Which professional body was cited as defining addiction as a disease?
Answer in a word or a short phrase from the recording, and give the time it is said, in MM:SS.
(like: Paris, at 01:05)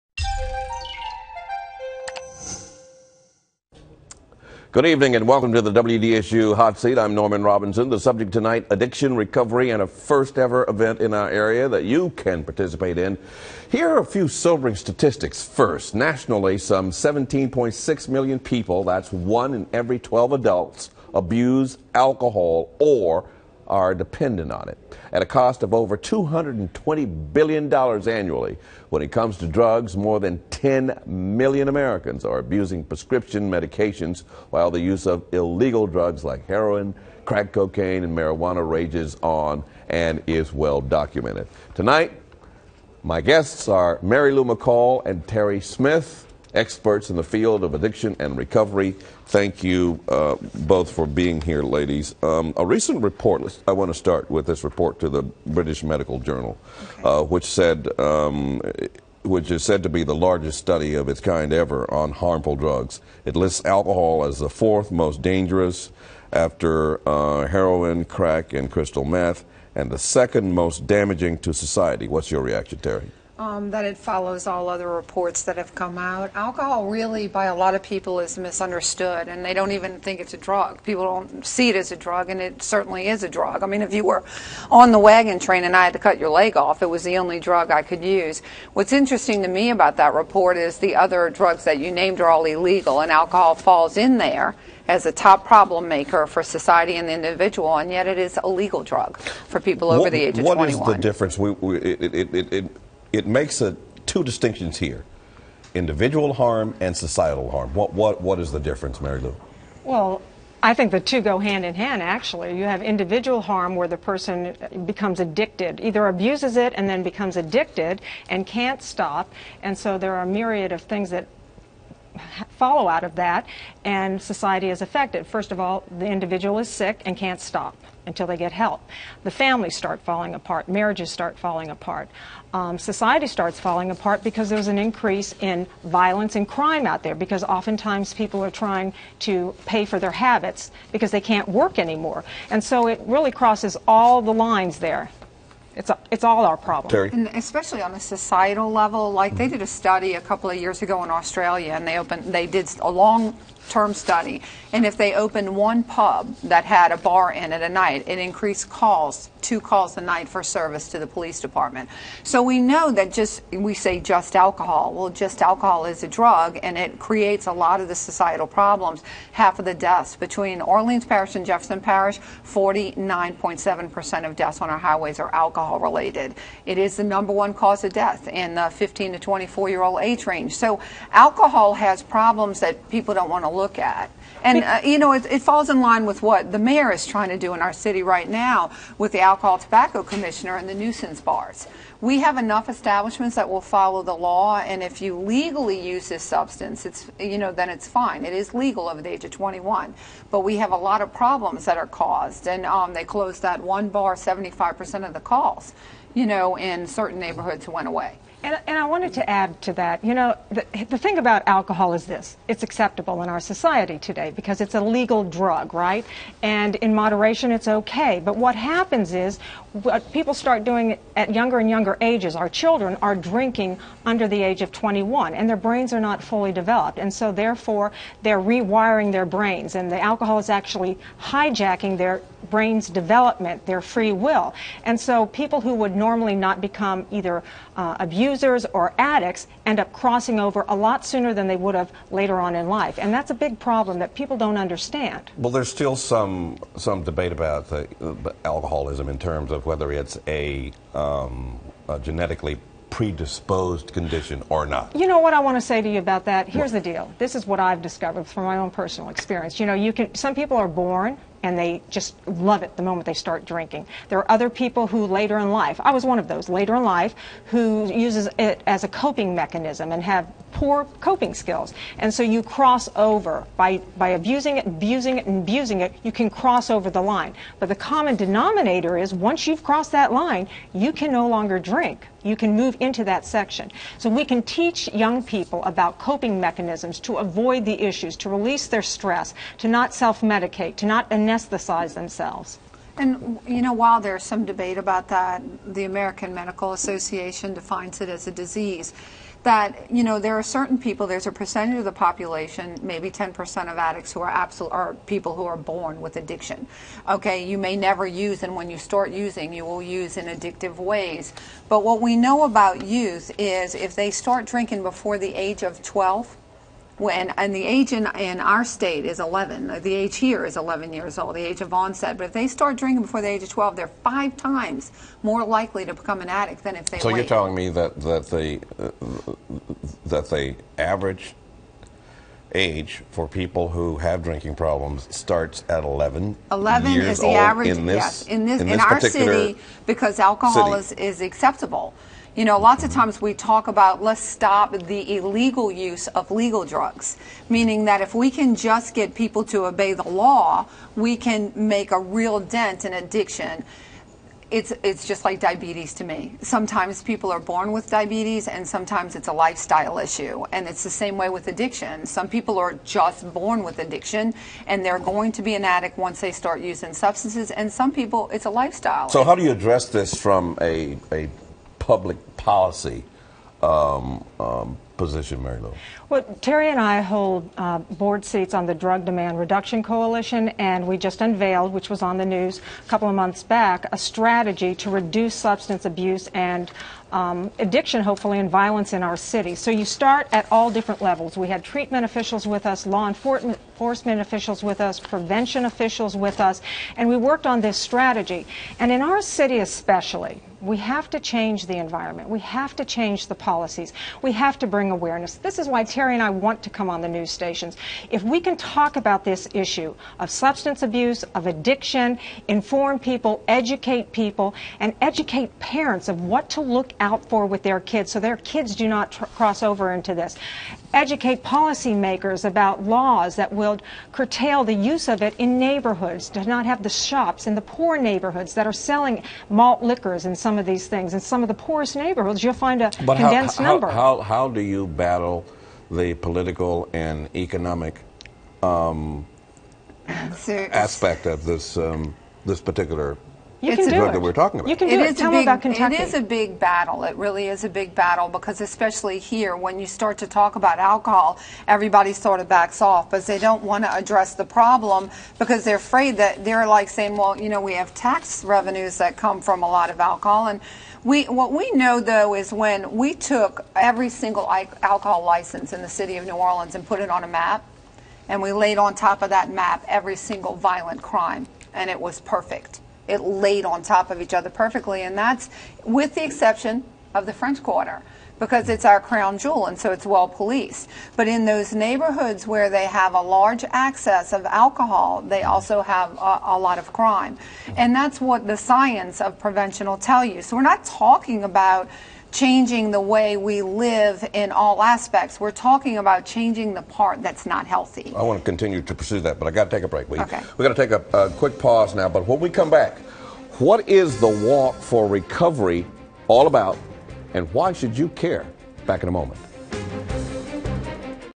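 American Medical Association, at 04:55.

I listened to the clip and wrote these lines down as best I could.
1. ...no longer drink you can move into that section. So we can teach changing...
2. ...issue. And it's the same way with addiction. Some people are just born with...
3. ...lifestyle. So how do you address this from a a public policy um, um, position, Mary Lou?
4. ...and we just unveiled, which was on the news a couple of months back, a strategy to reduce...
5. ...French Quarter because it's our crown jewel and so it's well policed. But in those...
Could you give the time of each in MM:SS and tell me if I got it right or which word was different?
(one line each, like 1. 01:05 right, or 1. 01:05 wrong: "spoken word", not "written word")
1. 04:41 wrong: "young", not "changing"
2. 05:59 right
3. 06:08 right
4. 06:20 right
5. 07:57 right.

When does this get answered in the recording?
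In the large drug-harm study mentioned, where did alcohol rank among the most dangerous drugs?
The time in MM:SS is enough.
01:04.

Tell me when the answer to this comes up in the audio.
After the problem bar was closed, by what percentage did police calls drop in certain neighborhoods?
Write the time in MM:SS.
03:24.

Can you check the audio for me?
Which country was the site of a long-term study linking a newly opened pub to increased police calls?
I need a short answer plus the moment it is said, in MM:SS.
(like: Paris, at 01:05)
Australia, at 02:31.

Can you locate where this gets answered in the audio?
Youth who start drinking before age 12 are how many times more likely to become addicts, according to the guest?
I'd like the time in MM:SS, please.
05:23.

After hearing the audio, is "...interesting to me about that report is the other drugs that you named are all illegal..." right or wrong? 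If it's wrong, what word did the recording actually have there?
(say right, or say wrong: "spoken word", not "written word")
right.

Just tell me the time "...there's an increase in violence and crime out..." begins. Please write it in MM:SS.
02:14.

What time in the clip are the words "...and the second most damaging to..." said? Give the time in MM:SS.
01:09.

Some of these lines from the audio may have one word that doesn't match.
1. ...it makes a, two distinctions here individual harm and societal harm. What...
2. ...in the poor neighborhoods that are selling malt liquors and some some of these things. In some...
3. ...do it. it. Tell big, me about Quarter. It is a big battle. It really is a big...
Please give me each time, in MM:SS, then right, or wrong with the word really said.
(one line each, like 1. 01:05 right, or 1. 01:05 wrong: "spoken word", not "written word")
1. 01:43 right
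2. 07:07 right
3. 07:24 wrong: "Kentucky", not "Quarter".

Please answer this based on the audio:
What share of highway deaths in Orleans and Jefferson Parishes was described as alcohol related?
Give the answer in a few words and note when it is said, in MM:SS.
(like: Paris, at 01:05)
49.7%, at 02:52.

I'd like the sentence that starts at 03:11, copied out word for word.
We have enough establishments that will follow the law, and if you legally use this substance, it's, you know, then it's fine.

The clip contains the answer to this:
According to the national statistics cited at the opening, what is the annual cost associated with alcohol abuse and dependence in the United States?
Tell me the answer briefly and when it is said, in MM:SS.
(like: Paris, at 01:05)
over $220 billion, at 00:25.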